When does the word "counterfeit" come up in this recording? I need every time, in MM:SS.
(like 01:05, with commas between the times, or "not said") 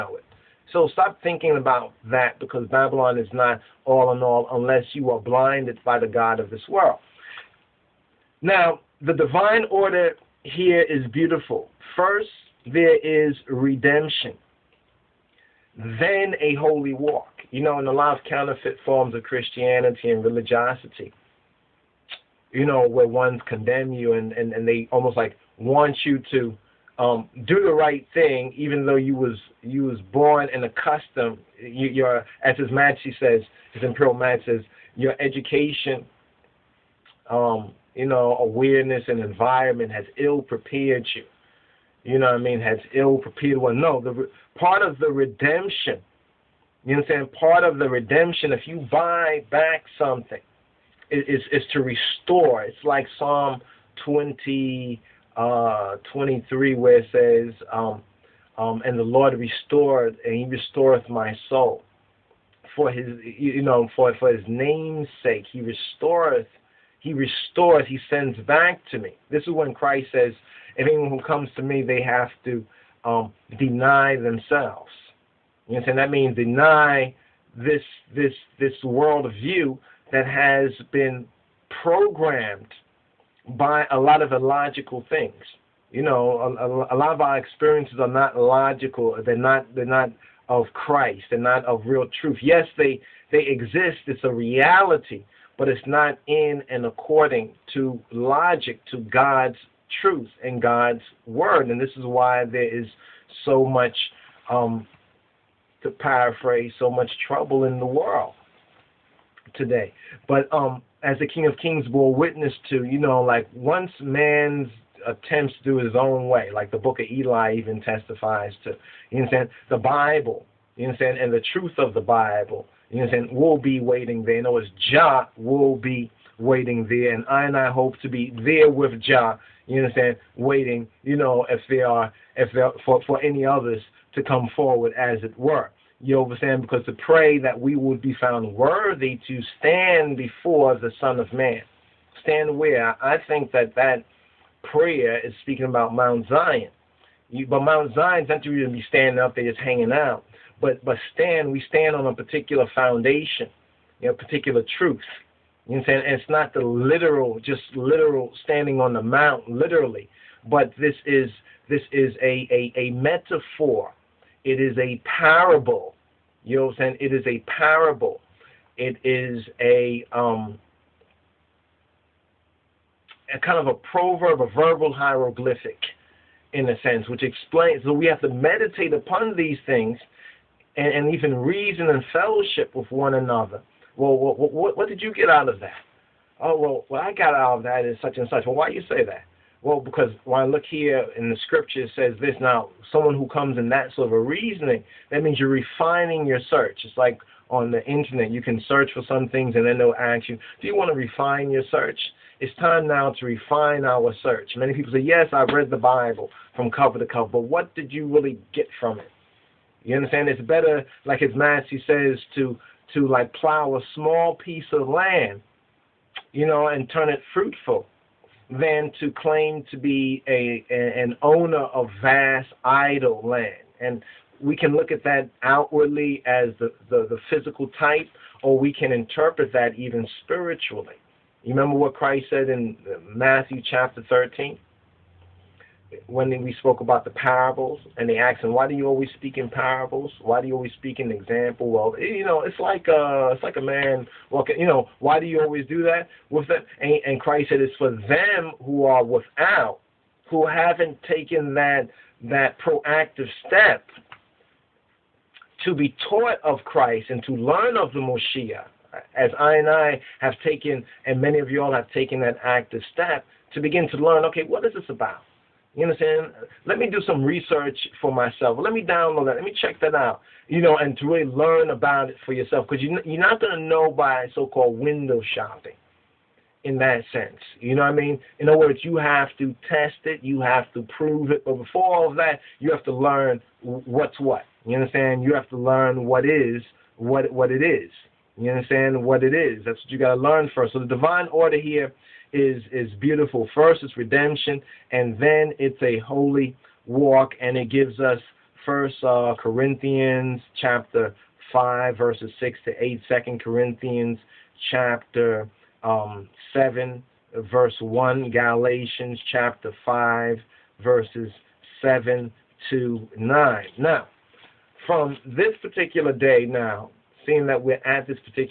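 00:18.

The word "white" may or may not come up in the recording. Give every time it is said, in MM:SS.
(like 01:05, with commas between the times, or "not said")
not said.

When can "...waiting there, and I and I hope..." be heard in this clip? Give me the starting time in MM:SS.
02:06.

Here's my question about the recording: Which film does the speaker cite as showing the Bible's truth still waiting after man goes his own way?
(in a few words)
The Book of Eli.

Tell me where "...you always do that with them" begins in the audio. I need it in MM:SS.
04:05.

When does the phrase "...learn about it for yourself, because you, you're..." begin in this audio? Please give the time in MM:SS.
04:31.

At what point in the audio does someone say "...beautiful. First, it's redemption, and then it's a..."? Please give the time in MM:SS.
04:52.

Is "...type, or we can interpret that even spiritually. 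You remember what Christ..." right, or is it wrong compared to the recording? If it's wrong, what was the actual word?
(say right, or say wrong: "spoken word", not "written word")
right.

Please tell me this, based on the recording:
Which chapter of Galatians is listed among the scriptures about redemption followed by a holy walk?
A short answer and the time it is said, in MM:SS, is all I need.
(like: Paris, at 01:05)
Chapter 5, at 05:08.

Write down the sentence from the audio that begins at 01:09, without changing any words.
This is when Christ says, Anyone who comes to me, they have to um, deny themselves.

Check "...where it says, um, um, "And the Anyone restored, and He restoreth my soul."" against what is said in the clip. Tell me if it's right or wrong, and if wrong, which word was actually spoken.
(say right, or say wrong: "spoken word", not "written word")
wrong: "Lord", not "Anyone".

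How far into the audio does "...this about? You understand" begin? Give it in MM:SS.
04:24.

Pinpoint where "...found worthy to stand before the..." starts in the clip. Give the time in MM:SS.
02:18.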